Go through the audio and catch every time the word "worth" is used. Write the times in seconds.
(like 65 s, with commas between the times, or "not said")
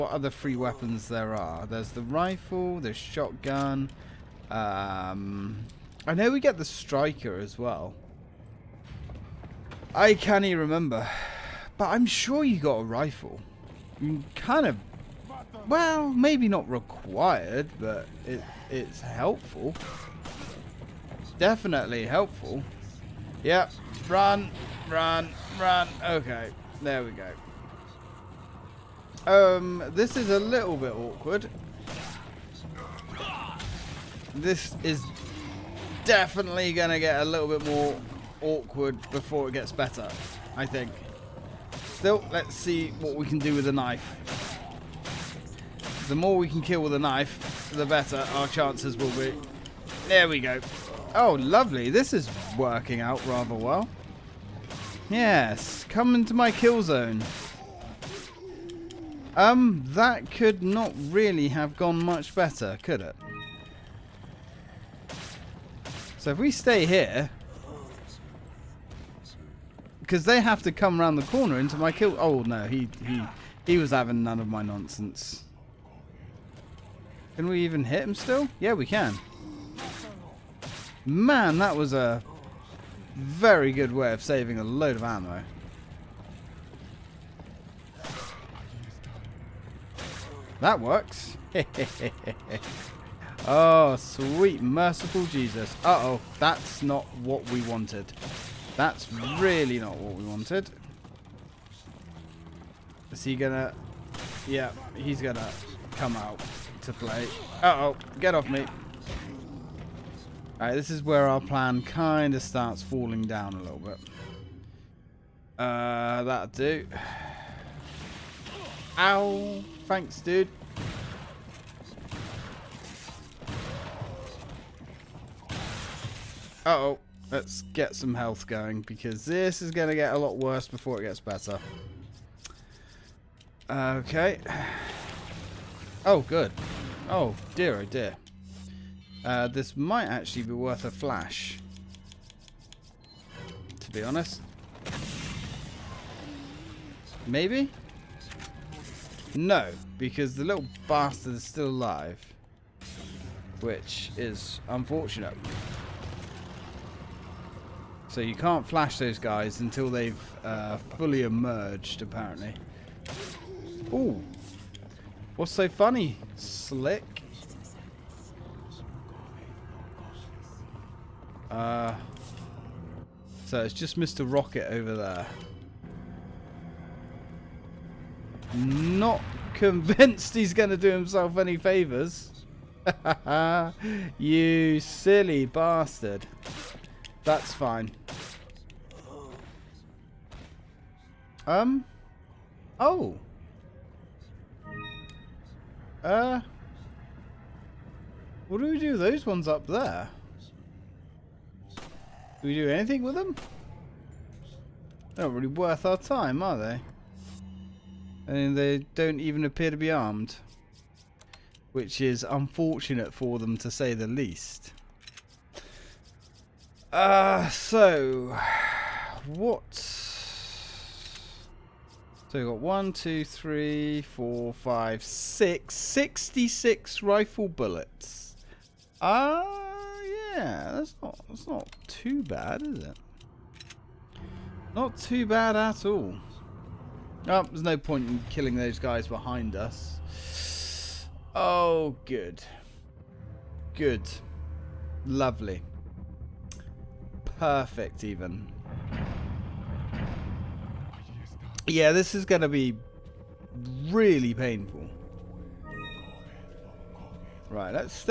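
140 s, 205 s.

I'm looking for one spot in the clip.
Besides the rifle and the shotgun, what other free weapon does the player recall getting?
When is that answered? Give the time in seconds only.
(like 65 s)
6 s.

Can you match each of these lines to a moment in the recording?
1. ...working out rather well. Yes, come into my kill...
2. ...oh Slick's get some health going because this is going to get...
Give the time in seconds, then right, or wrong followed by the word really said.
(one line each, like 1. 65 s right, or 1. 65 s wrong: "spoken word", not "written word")
1. 52 s right
2. 126 s wrong: "Let", not "Slick".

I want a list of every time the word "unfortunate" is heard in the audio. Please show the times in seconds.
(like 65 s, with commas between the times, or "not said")
154 s, 212 s.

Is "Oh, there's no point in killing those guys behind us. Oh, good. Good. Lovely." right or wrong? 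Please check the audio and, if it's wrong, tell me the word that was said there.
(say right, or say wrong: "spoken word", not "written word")
right.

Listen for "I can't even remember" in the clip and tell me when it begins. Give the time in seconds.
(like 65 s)
9 s.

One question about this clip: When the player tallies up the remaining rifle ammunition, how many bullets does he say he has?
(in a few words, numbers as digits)
66.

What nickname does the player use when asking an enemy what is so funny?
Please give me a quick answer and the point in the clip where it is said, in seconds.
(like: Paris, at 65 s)
Slick, at 166 s.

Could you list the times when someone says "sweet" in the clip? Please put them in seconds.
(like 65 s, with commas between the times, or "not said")
93 s.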